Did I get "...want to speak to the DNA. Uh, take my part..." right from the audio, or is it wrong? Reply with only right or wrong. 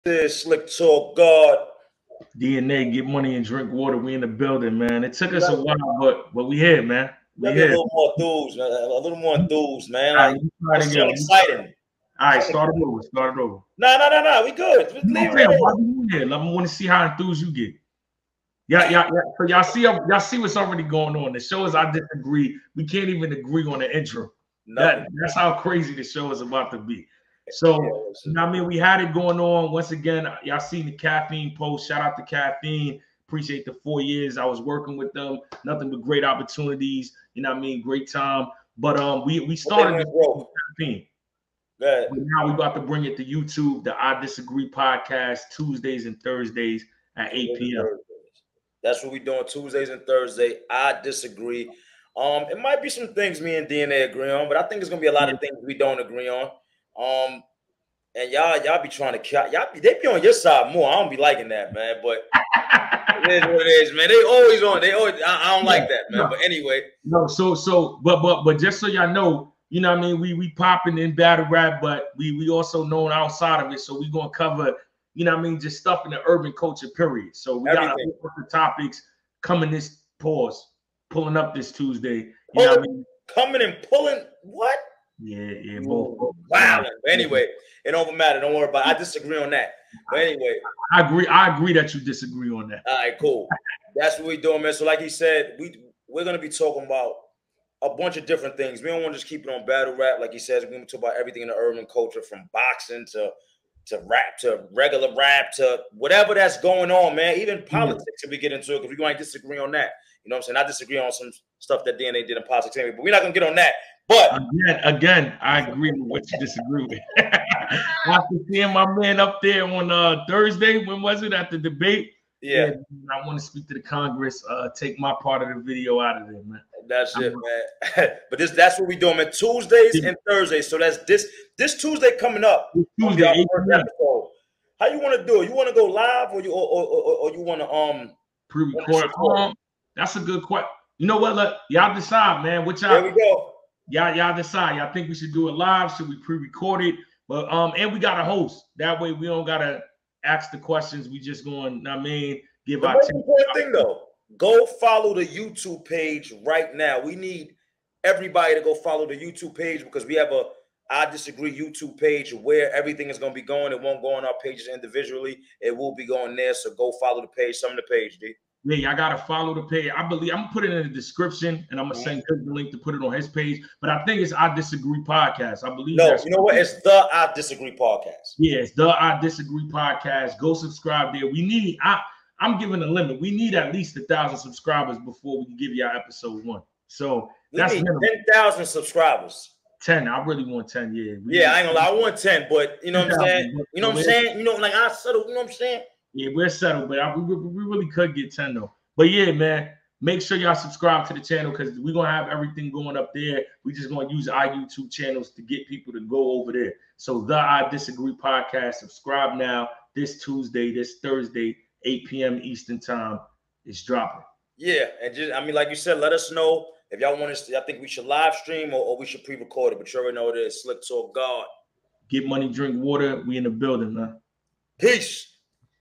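wrong.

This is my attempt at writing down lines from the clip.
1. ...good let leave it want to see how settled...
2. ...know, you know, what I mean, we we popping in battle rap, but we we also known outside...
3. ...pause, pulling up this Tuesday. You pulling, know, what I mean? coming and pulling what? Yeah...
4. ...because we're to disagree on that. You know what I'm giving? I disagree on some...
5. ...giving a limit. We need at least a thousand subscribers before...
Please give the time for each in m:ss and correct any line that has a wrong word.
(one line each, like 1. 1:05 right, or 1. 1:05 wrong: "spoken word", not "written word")
1. 0:14 wrong: "enthused", not "settled"
2. 1:09 right
3. 1:20 right
4. 1:48 wrong: "saying", not "giving"
5. 3:02 right.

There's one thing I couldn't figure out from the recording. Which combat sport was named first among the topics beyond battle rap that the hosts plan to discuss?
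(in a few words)
Boxing.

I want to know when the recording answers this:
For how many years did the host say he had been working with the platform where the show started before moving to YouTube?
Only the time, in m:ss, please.
0:33.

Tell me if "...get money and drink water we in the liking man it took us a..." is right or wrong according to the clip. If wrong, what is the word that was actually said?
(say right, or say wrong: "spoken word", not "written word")
wrong: "building", not "liking".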